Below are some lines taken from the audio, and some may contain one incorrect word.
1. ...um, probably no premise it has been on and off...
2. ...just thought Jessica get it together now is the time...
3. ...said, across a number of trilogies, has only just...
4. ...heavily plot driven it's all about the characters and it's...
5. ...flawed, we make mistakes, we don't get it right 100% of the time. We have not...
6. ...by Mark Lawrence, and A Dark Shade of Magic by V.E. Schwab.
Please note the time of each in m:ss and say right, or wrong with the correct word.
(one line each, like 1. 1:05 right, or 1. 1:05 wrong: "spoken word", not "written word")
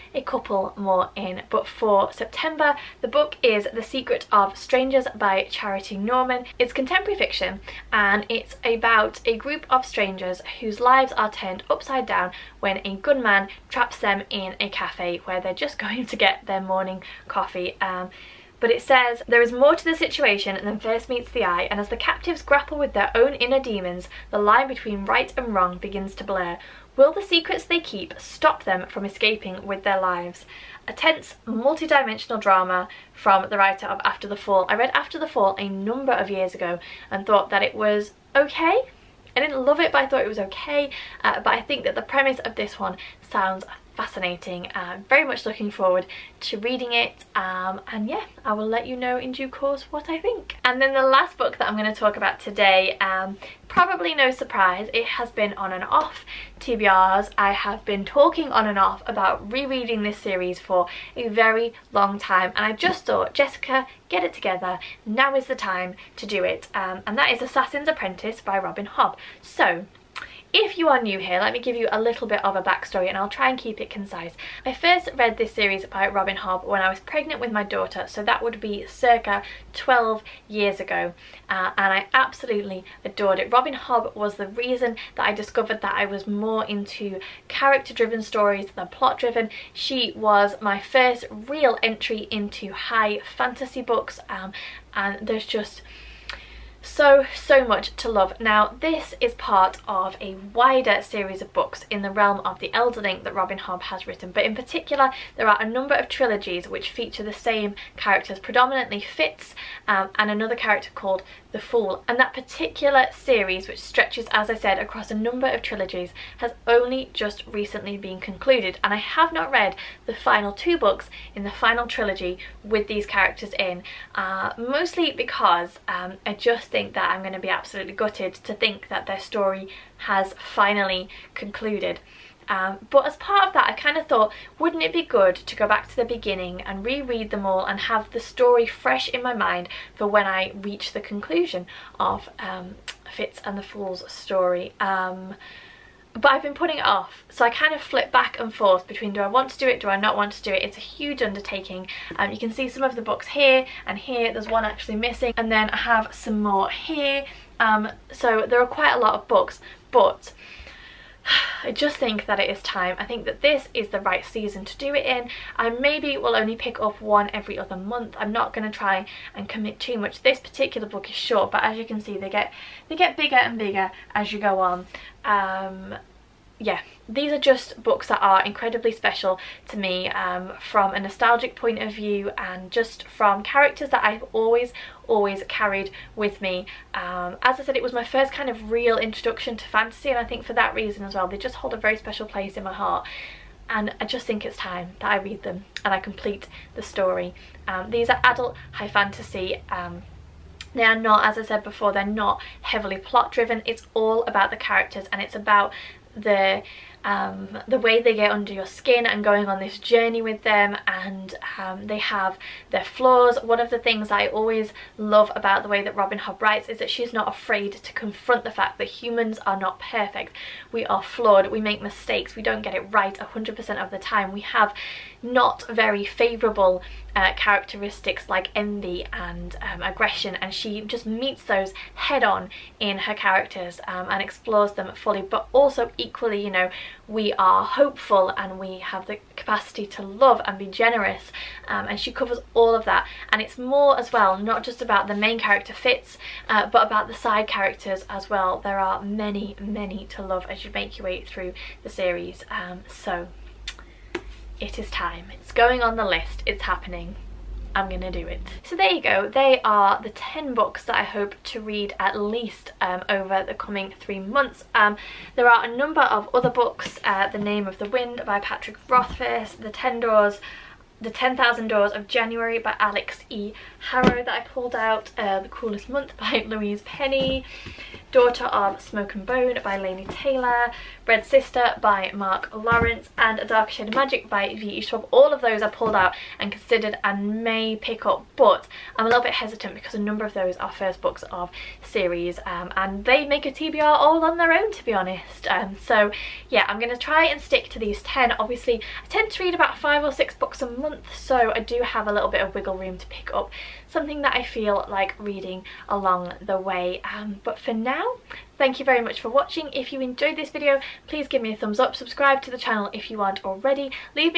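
1. 0:52 wrong: "surprise", not "premise"
2. 1:02 right
3. 1:54 right
4. 3:22 right
5. 3:41 right
6. 4:41 right.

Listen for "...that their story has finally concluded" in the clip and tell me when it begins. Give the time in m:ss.
2:08.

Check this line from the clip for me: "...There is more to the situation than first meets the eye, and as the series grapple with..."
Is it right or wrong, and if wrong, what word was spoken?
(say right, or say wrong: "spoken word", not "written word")
wrong: "captives", not "series".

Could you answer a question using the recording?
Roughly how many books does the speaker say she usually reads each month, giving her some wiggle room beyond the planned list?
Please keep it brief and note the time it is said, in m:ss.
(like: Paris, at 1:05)
5 or 6, at 4:59.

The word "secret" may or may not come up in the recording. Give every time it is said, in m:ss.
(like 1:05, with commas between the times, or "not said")
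0:03, 0:27.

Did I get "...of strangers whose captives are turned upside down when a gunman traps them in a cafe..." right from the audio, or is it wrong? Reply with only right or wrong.
wrong.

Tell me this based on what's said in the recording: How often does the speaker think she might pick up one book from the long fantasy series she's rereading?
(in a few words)
every other month.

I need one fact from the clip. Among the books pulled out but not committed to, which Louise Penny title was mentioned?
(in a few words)
The Cruelest Month.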